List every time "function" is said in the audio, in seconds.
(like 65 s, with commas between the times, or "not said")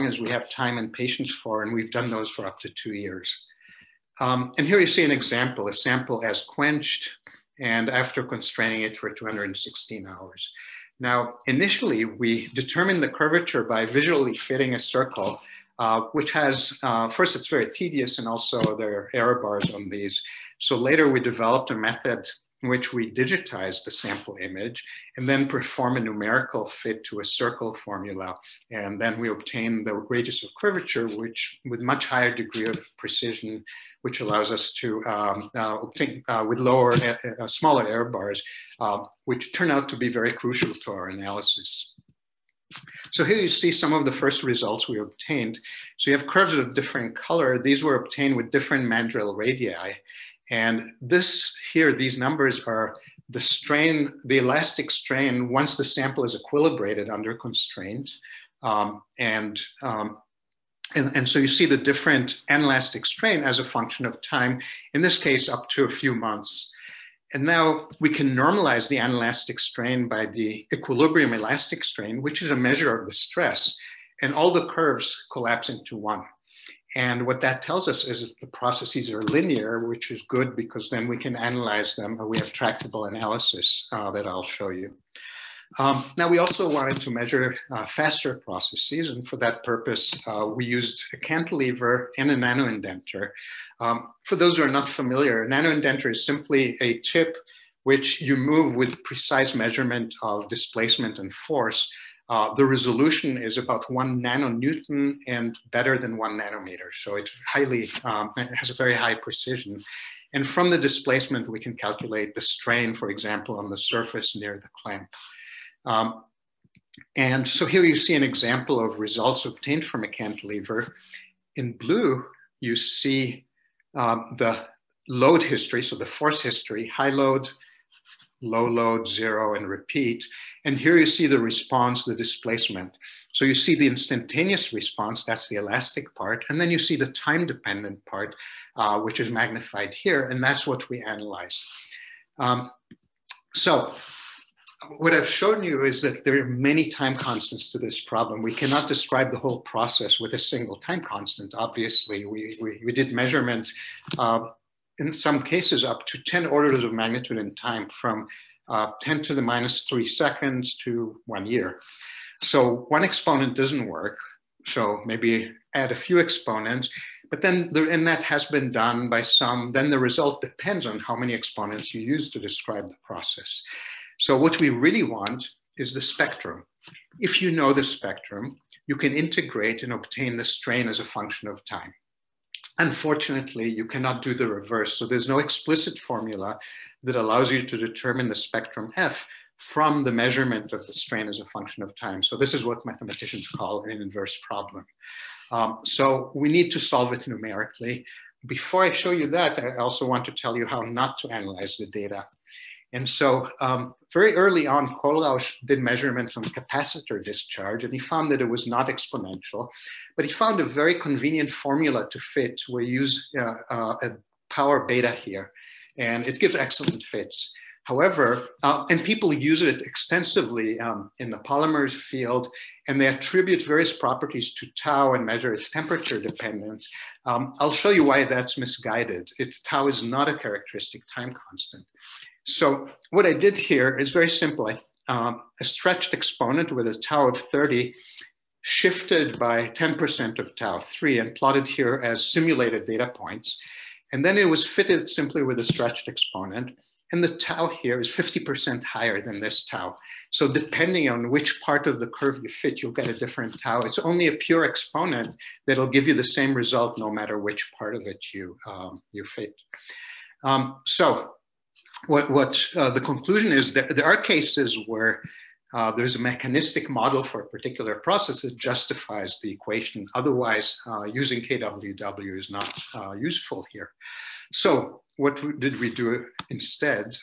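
63 s, 181 s, 191 s.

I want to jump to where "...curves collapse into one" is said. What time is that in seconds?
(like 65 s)
74 s.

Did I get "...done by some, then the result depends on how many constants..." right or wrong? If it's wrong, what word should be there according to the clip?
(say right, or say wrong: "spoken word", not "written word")
wrong: "exponents", not "constants".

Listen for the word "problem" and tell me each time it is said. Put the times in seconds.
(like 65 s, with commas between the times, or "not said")
148 s, 194 s.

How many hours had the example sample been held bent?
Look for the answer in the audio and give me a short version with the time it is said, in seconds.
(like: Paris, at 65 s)
216 hours, at 9 s.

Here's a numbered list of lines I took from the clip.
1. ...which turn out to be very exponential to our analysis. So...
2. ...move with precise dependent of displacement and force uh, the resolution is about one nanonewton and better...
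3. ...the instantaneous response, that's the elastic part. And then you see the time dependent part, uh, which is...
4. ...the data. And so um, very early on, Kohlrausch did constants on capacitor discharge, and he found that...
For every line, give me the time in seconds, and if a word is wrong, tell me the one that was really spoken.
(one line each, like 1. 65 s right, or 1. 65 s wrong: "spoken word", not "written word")
1. 39 s wrong: "crucial", not "exponential"
2. 98 s wrong: "measurement", not "dependent"
3. 133 s right
4. 201 s wrong: "measurements", not "constants".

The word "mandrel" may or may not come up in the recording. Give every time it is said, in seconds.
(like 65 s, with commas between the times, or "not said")
48 s.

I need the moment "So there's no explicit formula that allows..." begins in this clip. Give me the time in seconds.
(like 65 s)
184 s.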